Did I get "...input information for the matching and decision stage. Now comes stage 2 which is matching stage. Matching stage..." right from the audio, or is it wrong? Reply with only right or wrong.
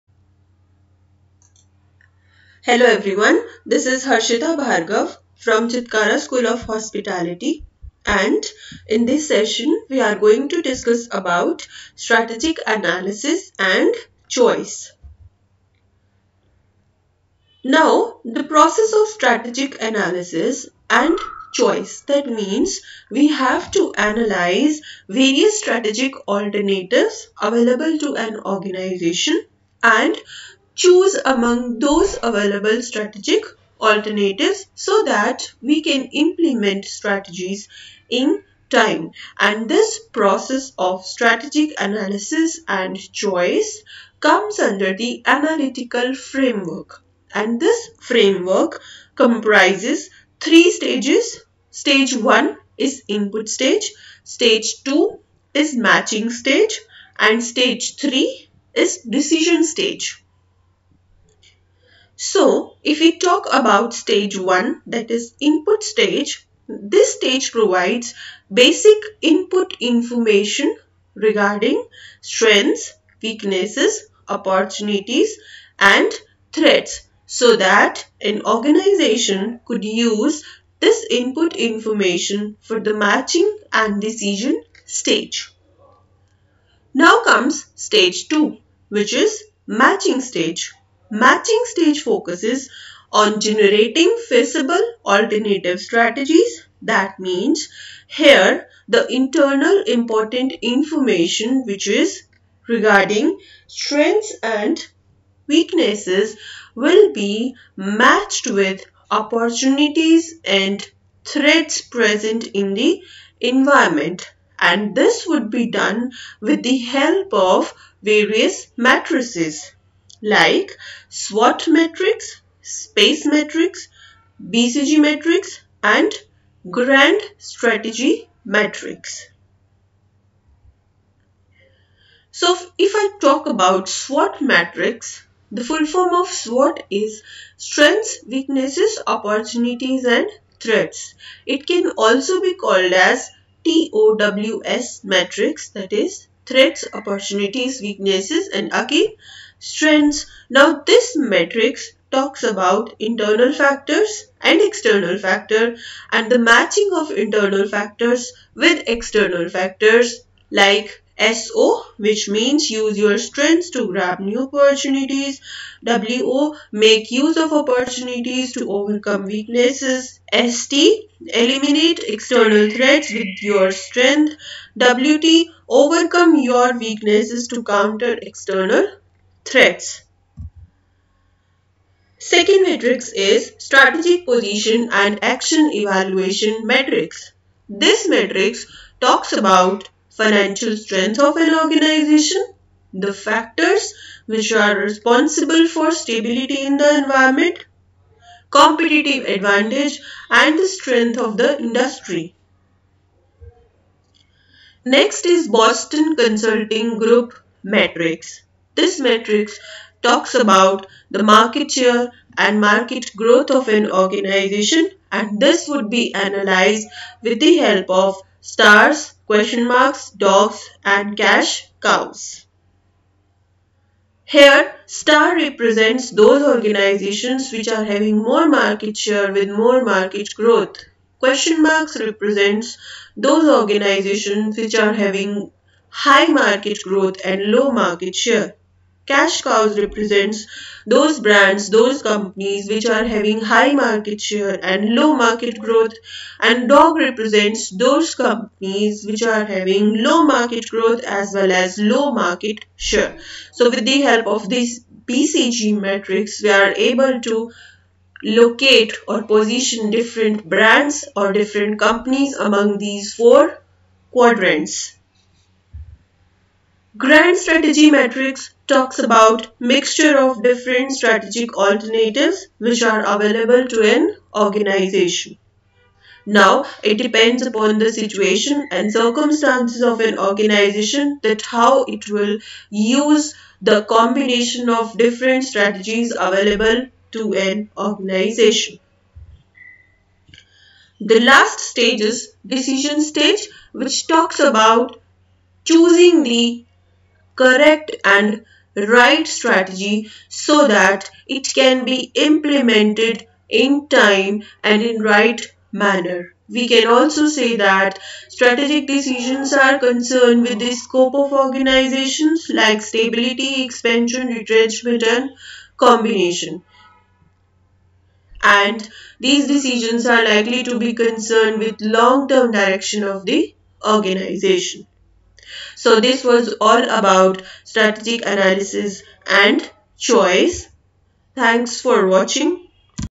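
right.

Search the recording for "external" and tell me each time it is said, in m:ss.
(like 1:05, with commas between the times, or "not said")
2:34, 2:38, 2:52, 2:58.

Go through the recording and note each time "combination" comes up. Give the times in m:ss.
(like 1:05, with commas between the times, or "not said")
4:43, 5:15.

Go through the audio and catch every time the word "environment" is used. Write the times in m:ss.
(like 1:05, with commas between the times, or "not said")
1:53, 3:16.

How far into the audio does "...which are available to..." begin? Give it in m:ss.
4:32.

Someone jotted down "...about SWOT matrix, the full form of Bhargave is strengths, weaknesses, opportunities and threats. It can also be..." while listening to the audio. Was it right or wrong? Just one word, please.
wrong.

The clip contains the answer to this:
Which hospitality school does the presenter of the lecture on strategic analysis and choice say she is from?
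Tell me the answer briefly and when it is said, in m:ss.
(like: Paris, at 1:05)
Chitkara School of Hospitality, at 0:05.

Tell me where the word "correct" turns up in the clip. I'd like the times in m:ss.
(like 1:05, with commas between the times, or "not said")
4:57.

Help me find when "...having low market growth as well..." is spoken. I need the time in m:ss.
4:09.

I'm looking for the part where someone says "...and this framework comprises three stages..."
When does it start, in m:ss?
0:47.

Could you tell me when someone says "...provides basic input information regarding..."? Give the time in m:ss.
1:07.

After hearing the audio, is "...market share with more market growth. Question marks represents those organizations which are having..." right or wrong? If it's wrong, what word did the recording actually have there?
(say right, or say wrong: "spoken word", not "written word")
right.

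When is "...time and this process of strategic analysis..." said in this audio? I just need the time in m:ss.
0:38.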